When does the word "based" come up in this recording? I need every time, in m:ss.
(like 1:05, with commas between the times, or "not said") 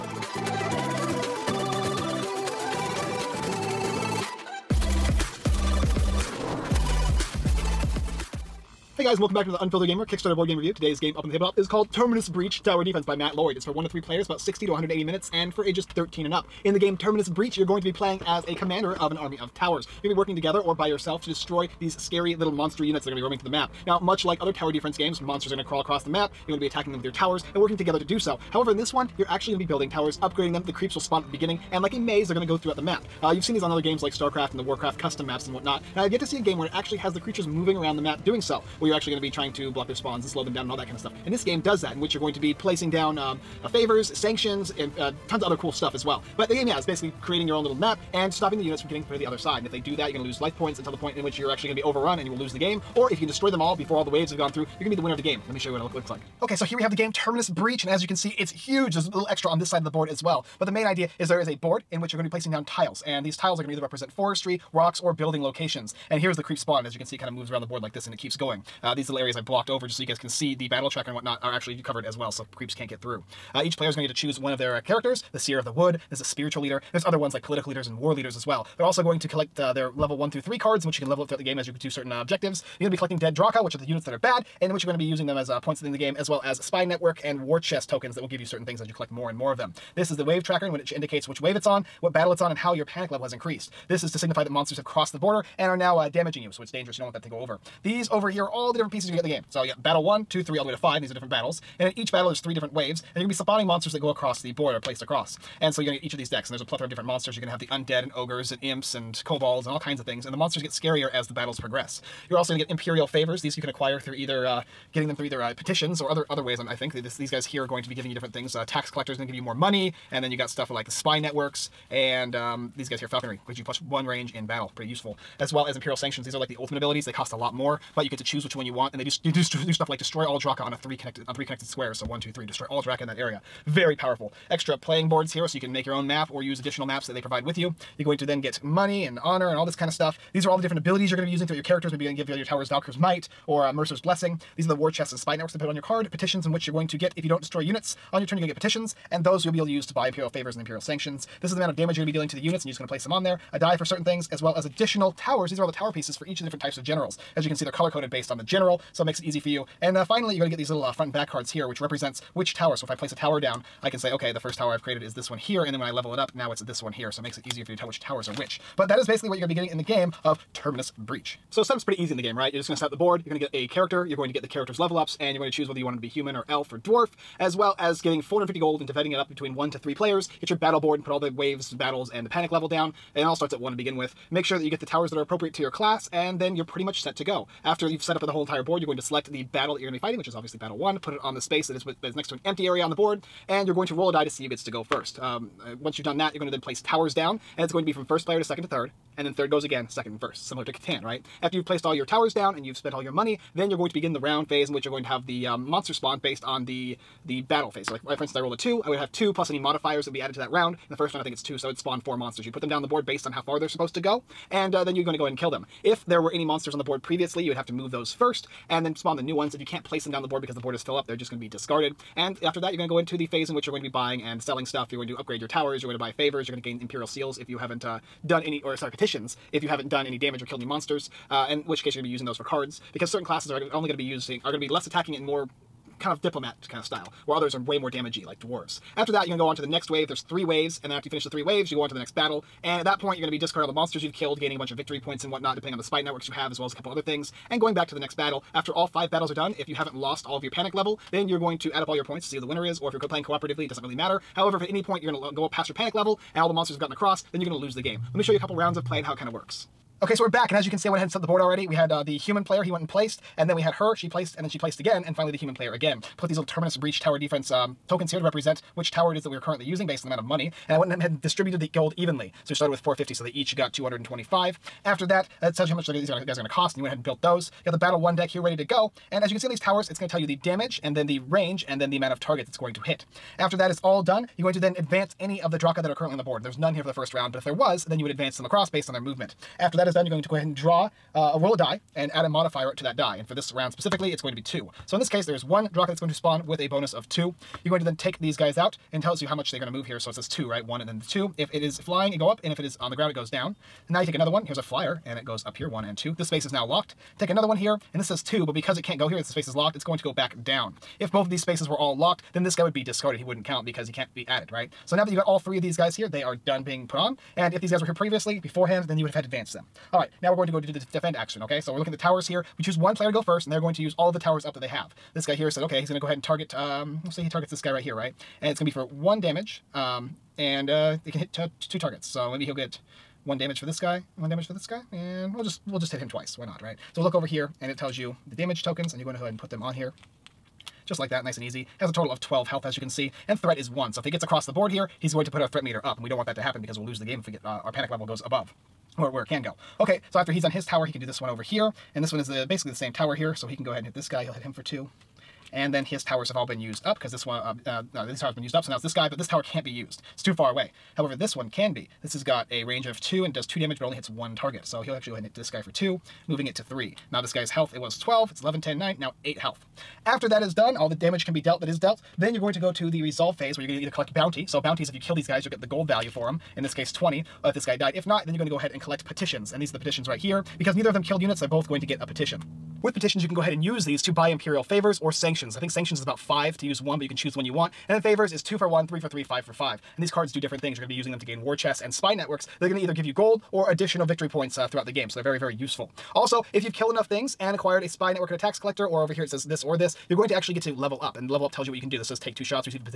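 2:38, 3:26, 3:33, 4:29, 4:48.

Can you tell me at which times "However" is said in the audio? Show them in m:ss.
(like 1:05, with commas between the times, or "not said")
0:28, 4:14, 6:00.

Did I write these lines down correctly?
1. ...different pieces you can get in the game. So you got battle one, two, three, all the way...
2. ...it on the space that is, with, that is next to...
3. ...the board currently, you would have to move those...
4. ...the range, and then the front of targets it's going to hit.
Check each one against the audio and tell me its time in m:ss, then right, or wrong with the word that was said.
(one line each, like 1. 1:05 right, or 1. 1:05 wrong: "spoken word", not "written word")
1. 1:38 right
2. 3:11 right
3. 3:36 wrong: "previously", not "currently"
4. 4:41 wrong: "amount", not "front".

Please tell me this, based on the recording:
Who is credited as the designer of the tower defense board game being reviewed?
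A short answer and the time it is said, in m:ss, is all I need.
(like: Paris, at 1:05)
Matt Lloyd, at 0:13.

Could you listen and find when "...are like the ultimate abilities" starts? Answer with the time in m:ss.
2:06.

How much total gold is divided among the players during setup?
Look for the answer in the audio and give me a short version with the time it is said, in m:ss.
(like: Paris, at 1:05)
450, at 2:58.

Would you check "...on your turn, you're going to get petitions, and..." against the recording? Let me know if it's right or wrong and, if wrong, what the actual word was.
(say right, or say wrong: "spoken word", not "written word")
right.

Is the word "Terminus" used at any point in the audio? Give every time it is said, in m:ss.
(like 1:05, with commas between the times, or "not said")
0:11, 0:16, 0:57, 2:50, 4:26.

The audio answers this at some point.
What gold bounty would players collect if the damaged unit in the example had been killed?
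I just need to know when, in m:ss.
6:16.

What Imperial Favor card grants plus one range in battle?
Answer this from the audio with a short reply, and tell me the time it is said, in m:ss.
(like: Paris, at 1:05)
Falconry, at 2:03.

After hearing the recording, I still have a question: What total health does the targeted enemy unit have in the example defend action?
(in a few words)
12.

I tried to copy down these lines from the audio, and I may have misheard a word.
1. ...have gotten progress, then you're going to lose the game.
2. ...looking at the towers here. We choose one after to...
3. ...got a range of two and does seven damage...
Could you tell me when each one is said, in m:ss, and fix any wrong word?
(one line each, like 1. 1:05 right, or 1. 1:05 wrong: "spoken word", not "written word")
1. 4:16 wrong: "across", not "progress"
2. 5:21 wrong: "player", not "after"
3. 6:02 wrong: "two", not "seven".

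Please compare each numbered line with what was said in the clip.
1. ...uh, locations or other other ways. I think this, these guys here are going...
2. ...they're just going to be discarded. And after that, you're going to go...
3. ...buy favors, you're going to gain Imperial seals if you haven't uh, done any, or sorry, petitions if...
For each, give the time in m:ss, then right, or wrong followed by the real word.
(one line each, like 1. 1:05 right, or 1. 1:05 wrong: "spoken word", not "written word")
1. 1:55 wrong: "petitions", not "locations"
2. 3:41 right
3. 3:45 right.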